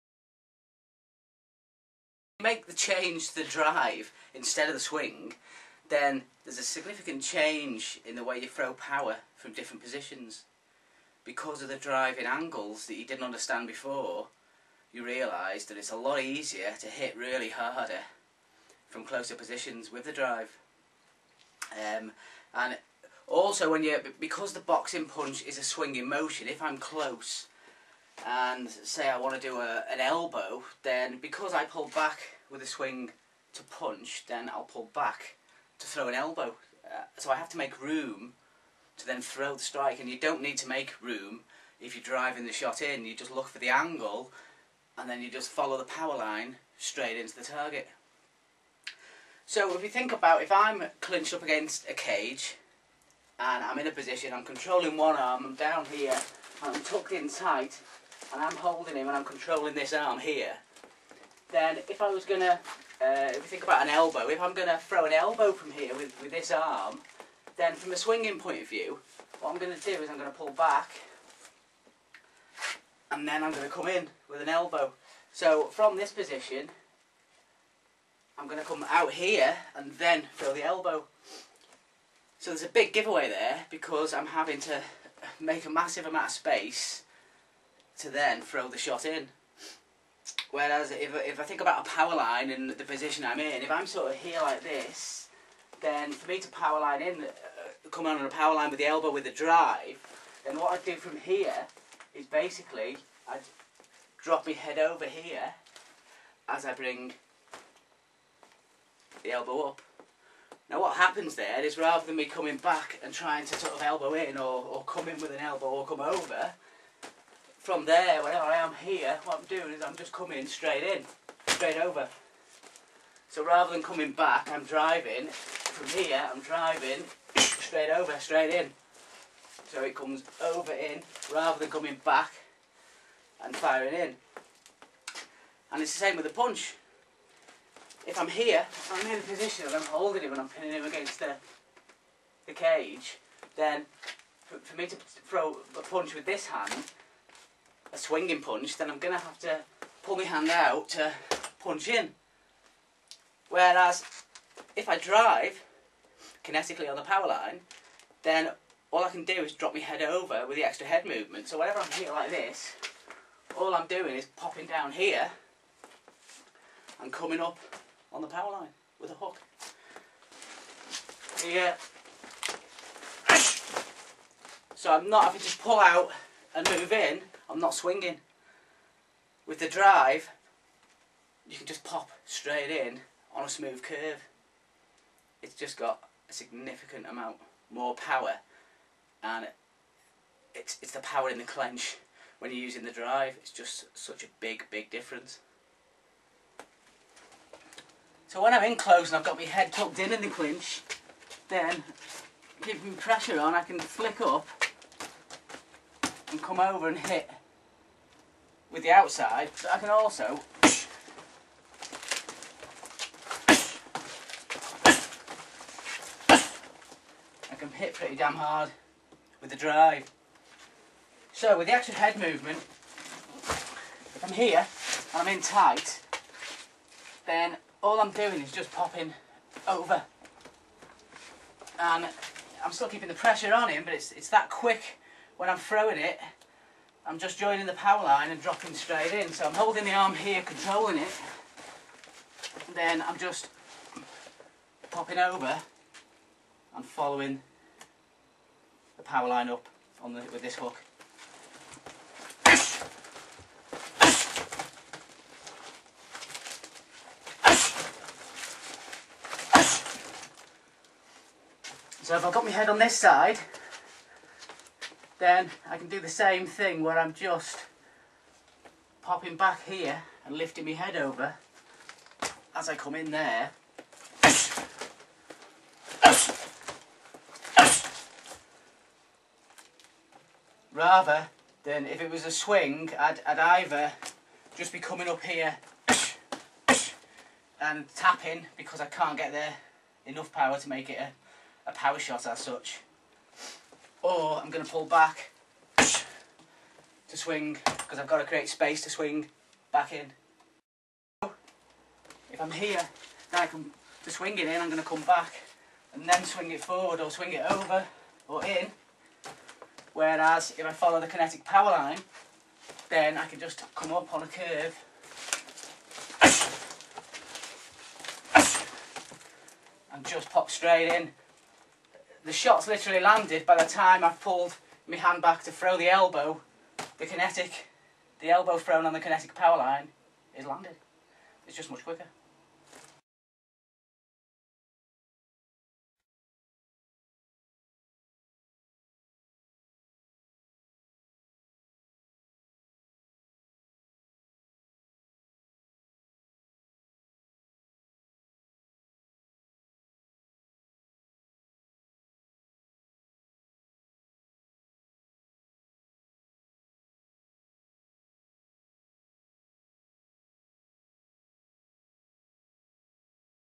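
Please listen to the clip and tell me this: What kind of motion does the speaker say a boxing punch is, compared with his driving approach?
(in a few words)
swinging motion.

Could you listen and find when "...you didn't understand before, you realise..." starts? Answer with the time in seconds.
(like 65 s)
12 s.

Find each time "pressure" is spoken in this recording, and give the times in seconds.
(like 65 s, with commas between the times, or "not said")
202 s, 233 s.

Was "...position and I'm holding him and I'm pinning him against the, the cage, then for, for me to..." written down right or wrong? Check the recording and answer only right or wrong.
right.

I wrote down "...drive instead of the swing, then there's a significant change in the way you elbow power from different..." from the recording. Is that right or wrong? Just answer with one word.
wrong.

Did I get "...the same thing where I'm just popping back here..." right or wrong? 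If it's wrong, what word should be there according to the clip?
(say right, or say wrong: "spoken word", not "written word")
right.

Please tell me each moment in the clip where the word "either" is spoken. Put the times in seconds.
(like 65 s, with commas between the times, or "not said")
283 s.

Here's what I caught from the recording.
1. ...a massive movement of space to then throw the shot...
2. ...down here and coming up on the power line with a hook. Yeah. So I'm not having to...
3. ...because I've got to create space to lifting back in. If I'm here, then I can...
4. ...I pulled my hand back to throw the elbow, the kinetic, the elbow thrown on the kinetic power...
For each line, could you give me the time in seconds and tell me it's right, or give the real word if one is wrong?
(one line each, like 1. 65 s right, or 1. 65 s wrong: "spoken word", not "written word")
1. 85 s wrong: "amount", not "movement"
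2. 164 s right
3. 297 s wrong: "swing", not "lifting"
4. 324 s right.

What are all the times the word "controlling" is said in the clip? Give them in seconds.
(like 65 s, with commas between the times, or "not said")
54 s, 59 s, 240 s.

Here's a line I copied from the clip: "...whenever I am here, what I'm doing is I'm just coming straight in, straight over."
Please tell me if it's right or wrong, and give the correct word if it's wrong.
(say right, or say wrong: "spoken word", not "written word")
right.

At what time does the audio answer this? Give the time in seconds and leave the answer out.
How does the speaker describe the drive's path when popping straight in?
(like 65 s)
183 s.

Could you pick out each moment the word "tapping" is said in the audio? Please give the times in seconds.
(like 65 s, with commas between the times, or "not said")
287 s.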